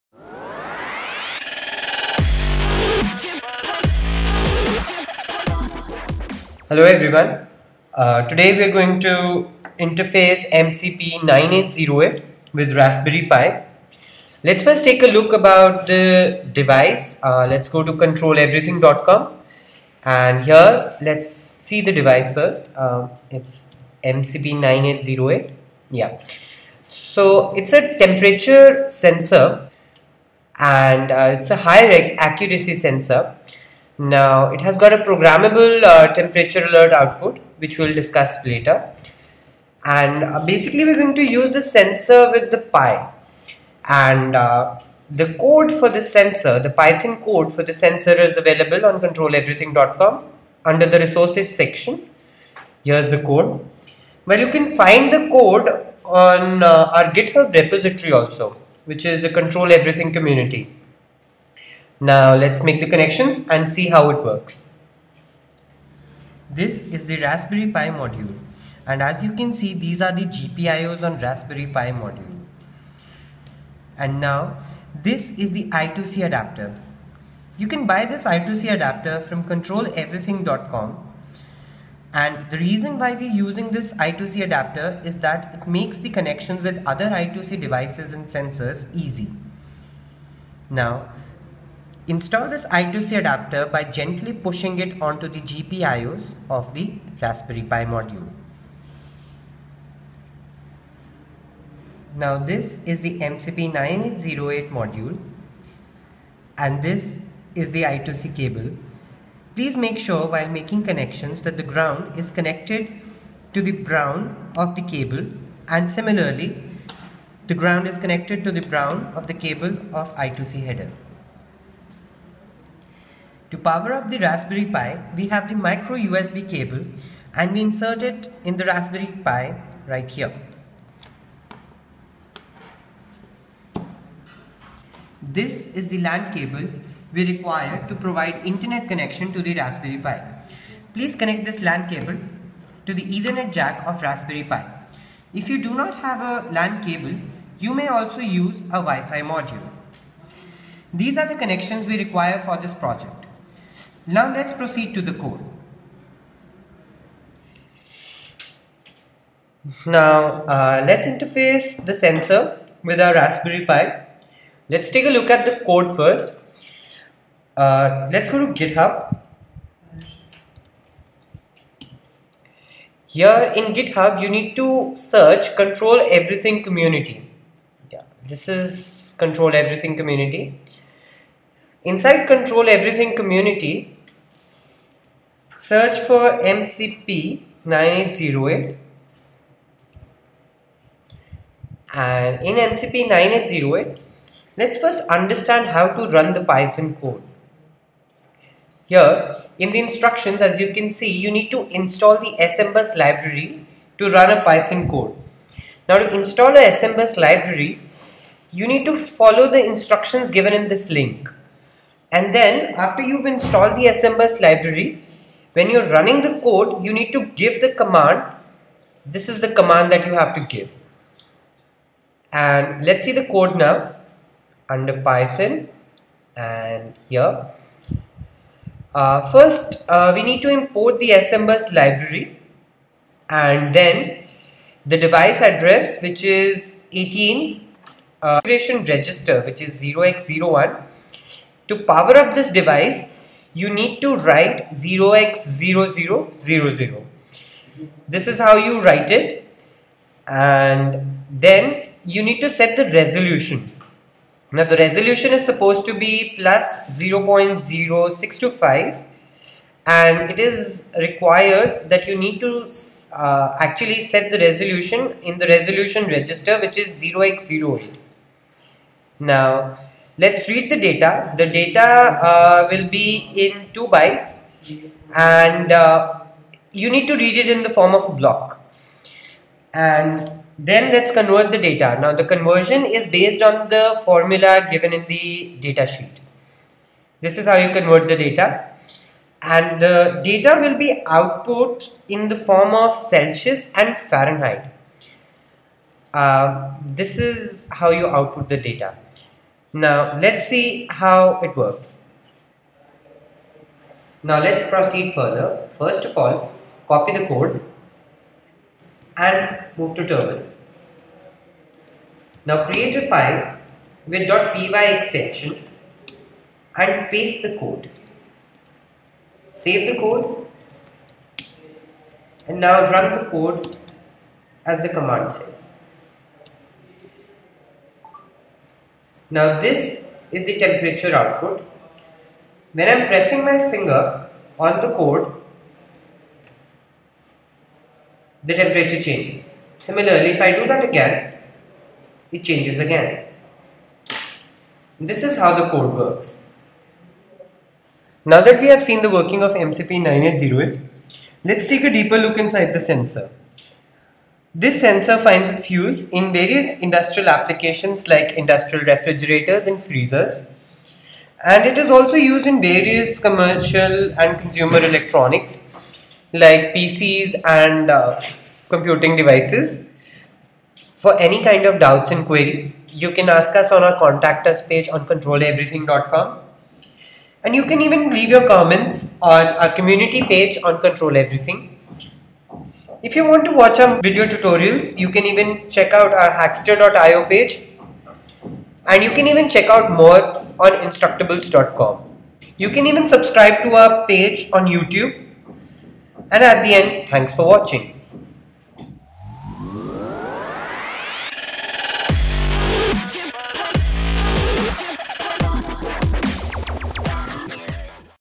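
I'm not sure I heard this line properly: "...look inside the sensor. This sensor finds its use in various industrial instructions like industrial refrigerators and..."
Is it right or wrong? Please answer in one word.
wrong.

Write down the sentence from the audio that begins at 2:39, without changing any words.
Now uh, let's interface the sensor with our Raspberry Pi.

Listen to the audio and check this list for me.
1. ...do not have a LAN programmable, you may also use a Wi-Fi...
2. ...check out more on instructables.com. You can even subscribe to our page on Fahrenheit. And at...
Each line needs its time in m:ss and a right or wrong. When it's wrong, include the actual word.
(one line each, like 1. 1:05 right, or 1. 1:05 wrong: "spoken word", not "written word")
1. 2:25 wrong: "cable", not "programmable"
2. 6:29 wrong: "YouTube", not "Fahrenheit".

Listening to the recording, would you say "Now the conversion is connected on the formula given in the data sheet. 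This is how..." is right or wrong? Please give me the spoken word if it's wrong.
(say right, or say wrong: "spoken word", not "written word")
wrong: "based", not "connected".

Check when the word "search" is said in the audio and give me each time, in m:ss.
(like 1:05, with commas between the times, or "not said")
2:54, 3:05.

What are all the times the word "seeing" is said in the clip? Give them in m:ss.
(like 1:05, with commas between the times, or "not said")
not said.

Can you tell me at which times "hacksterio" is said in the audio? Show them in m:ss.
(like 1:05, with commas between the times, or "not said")
6:26.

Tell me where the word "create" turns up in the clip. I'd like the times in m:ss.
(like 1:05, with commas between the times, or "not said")
5:12.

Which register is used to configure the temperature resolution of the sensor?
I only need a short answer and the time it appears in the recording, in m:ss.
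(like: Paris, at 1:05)
0x08, at 4:27.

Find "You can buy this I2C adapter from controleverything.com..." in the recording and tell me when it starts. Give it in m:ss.
1:17.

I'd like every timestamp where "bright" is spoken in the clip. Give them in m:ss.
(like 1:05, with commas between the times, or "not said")
not said.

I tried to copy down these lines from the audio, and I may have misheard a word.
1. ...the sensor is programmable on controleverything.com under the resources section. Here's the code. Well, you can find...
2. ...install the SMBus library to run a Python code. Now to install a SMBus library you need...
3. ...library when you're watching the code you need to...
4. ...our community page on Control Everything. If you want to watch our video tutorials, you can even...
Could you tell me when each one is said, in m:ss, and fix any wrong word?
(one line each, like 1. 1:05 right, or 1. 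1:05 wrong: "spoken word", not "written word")
1. 0:47 wrong: "available", not "programmable"
2. 3:21 right
3. 3:34 wrong: "running", not "watching"
4. 6:19 right.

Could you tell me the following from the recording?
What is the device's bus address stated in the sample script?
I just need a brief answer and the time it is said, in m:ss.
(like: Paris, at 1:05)
18, at 3:56.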